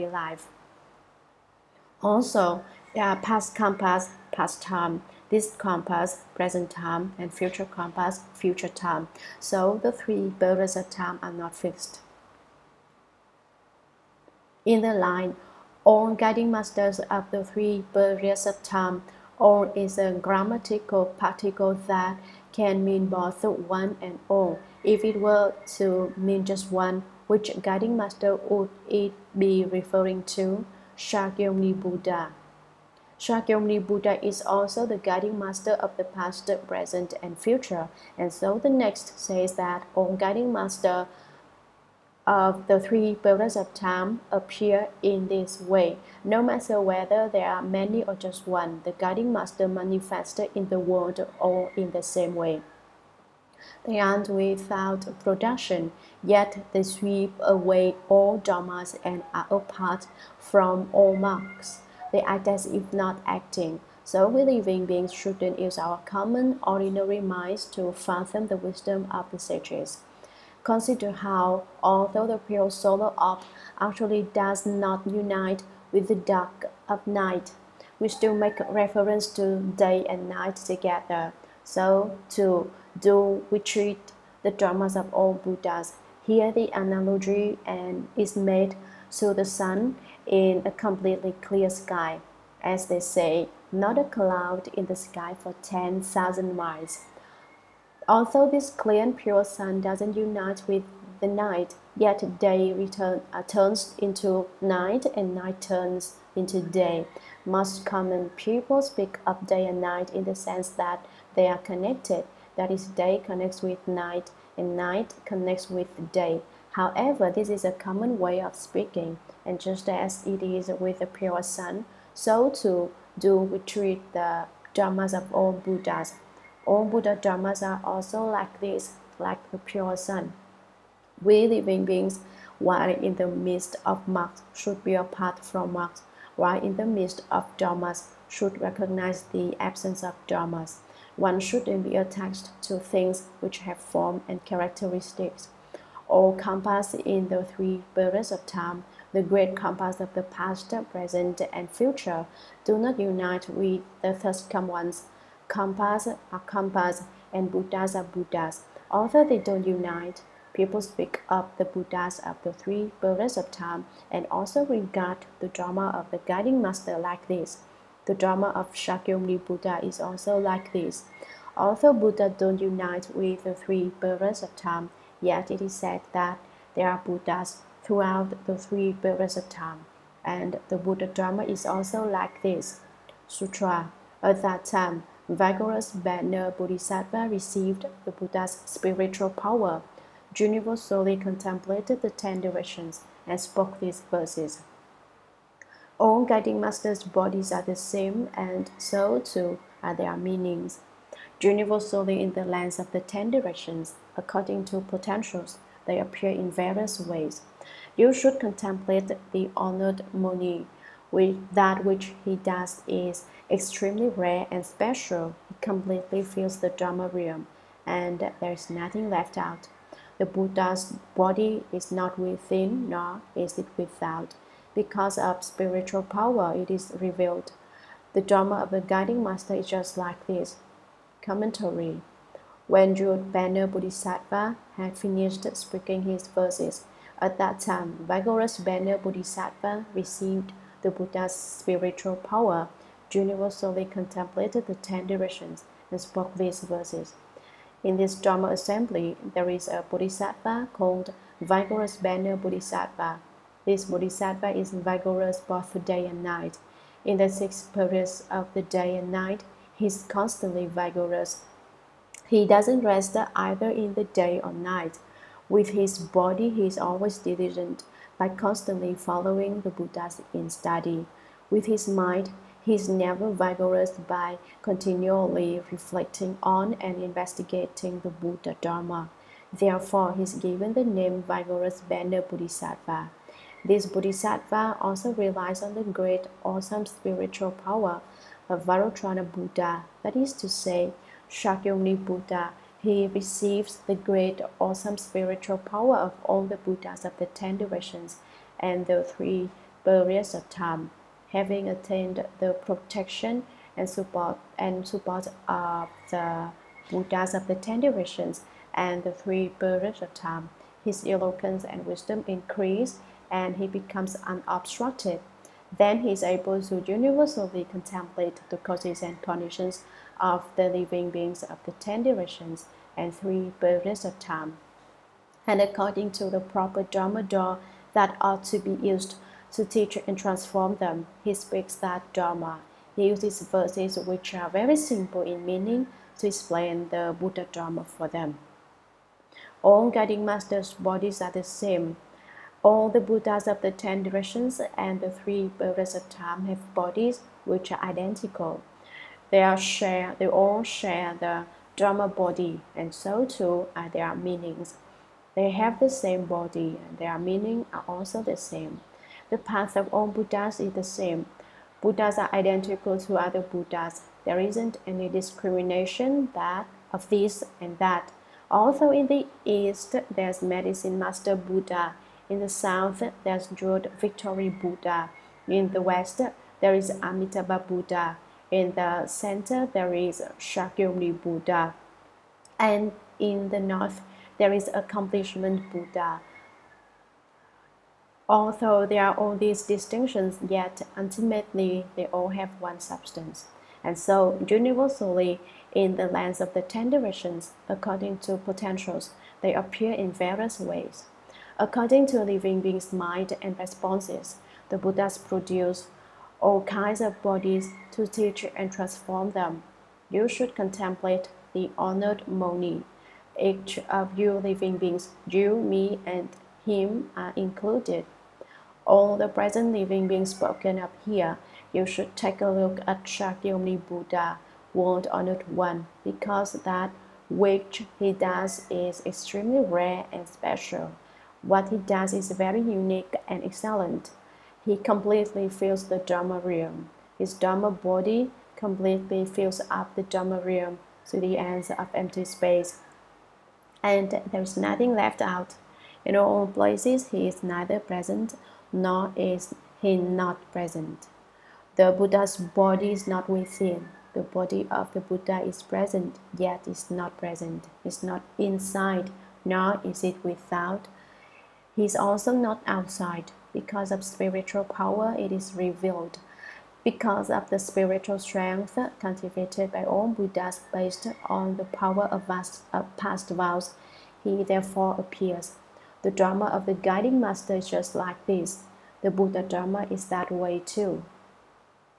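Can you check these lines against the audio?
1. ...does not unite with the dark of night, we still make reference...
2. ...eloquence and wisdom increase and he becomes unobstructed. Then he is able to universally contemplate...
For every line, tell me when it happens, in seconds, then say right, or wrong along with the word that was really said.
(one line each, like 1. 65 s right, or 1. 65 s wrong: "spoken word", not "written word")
1. 74 s right
2. 311 s right.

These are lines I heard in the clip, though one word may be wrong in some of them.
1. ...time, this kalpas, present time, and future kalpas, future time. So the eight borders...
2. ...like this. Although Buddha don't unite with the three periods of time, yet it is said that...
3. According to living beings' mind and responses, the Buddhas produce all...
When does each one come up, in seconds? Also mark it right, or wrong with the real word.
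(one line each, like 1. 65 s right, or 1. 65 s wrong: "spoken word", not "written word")
1. 4 s wrong: "three", not "eight"
2. 170 s right
3. 401 s right.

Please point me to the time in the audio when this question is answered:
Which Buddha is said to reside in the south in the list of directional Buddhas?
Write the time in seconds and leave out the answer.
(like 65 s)
373 s.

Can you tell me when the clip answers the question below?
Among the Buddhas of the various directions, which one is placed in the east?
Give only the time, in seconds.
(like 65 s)
370 s.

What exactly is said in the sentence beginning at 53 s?
They are not without production, yet they sweep away all dharmas and are apart from all marks.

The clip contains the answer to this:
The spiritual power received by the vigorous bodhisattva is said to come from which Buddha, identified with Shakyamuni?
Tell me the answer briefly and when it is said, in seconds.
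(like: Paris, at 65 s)
Vairochana Buddha, at 288 s.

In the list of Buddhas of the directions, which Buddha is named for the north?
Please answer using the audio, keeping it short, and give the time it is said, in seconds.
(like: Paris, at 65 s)
Accomplishment Buddha, at 384 s.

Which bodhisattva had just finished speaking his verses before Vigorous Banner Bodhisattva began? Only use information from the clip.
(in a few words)
Jeweled Banner Bodhisattva.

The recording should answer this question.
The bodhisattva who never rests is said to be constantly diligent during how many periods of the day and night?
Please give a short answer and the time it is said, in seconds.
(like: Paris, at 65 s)
6, at 257 s.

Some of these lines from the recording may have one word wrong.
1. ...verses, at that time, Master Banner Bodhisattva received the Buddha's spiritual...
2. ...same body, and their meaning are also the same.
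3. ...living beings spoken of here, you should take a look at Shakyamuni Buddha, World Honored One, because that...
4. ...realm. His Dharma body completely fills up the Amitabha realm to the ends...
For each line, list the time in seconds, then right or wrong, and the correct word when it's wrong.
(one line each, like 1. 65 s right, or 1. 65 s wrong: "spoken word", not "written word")
1. 236 s wrong: "Vigorous", not "Master"
2. 355 s right
3. 419 s right
4. 436 s wrong: "Dharma", not "Amitabha".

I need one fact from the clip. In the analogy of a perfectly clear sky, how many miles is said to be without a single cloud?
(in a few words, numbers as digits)
10,000.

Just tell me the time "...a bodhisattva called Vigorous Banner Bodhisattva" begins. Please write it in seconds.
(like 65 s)
249 s.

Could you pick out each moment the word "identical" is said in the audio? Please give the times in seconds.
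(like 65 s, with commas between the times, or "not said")
347 s, 362 s.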